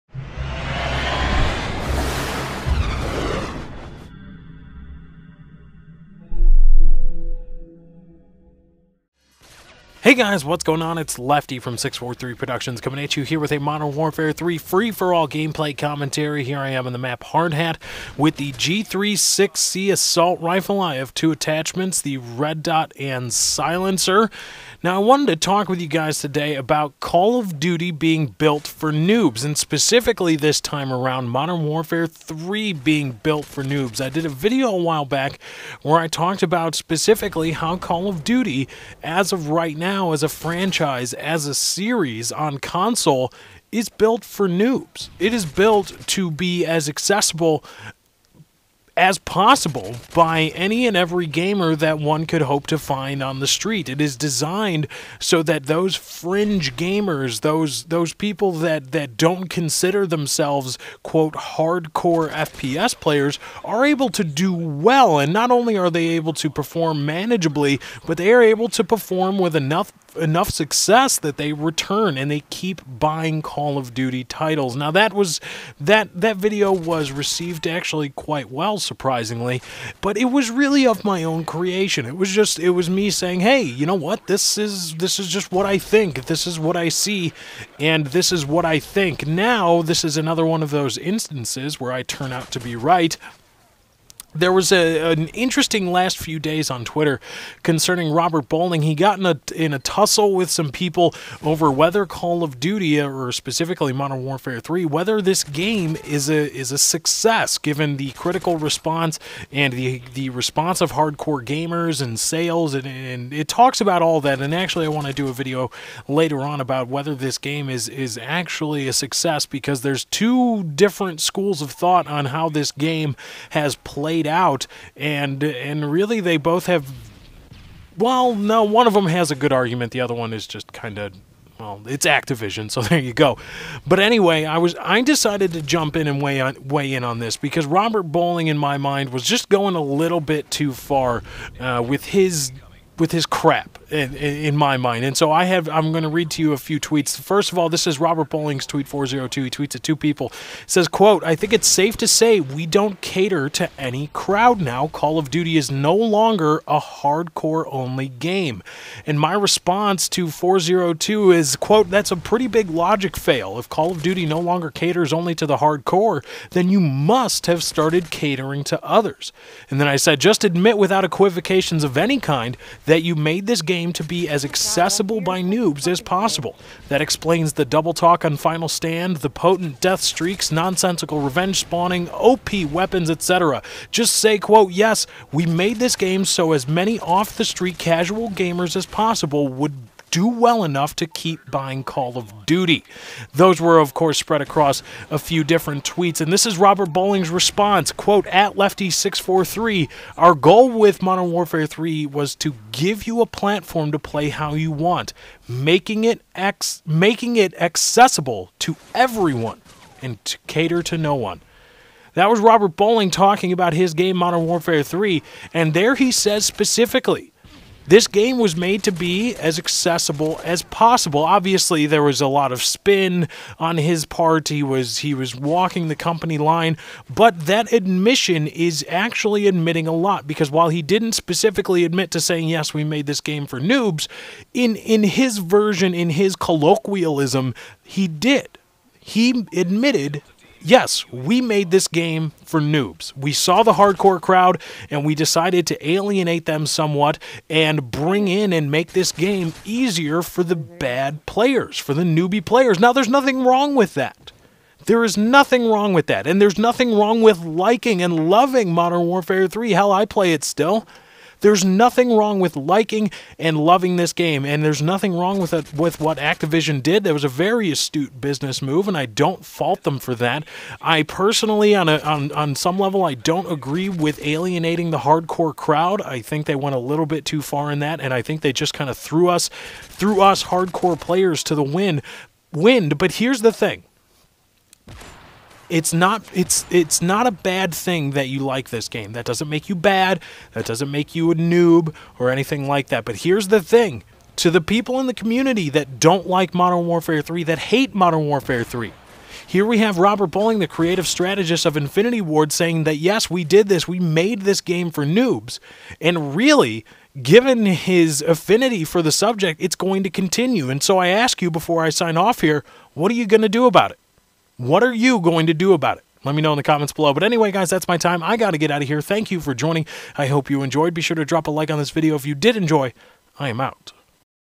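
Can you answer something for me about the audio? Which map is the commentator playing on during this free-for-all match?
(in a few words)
Hard Hat.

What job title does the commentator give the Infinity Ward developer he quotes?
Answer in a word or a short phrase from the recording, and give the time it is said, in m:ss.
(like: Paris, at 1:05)
creative strategist, at 5:00.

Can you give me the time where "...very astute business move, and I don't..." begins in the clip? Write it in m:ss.
4:27.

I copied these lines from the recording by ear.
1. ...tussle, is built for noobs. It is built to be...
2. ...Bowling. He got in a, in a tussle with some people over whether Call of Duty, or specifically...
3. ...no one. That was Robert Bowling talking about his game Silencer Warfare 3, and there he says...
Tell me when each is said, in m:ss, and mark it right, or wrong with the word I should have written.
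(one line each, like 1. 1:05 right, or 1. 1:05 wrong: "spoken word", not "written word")
1. 0:42 wrong: "console", not "tussle"
2. 1:38 right
3. 3:30 wrong: "Modern", not "Silencer".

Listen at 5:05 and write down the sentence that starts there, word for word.
And really, given his affinity for the subject, it's going to continue.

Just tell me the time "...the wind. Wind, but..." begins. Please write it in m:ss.
4:41.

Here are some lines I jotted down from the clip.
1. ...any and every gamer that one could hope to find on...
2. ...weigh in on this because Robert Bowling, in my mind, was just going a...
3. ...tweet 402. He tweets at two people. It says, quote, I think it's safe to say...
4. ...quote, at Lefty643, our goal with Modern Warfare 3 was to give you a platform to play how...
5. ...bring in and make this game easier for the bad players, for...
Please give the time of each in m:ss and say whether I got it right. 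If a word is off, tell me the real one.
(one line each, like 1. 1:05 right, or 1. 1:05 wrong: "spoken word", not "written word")
1. 0:50 right
2. 2:16 right
3. 2:28 right
4. 3:17 right
5. 4:07 right.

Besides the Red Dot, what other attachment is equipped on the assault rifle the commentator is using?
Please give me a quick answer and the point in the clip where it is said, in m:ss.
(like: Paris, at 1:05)
Silencer, at 0:23.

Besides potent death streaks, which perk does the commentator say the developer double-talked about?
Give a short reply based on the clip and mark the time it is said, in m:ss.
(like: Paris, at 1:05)
Final Stand, at 2:58.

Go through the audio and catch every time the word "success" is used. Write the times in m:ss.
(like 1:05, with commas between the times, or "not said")
1:10, 1:46, 1:58.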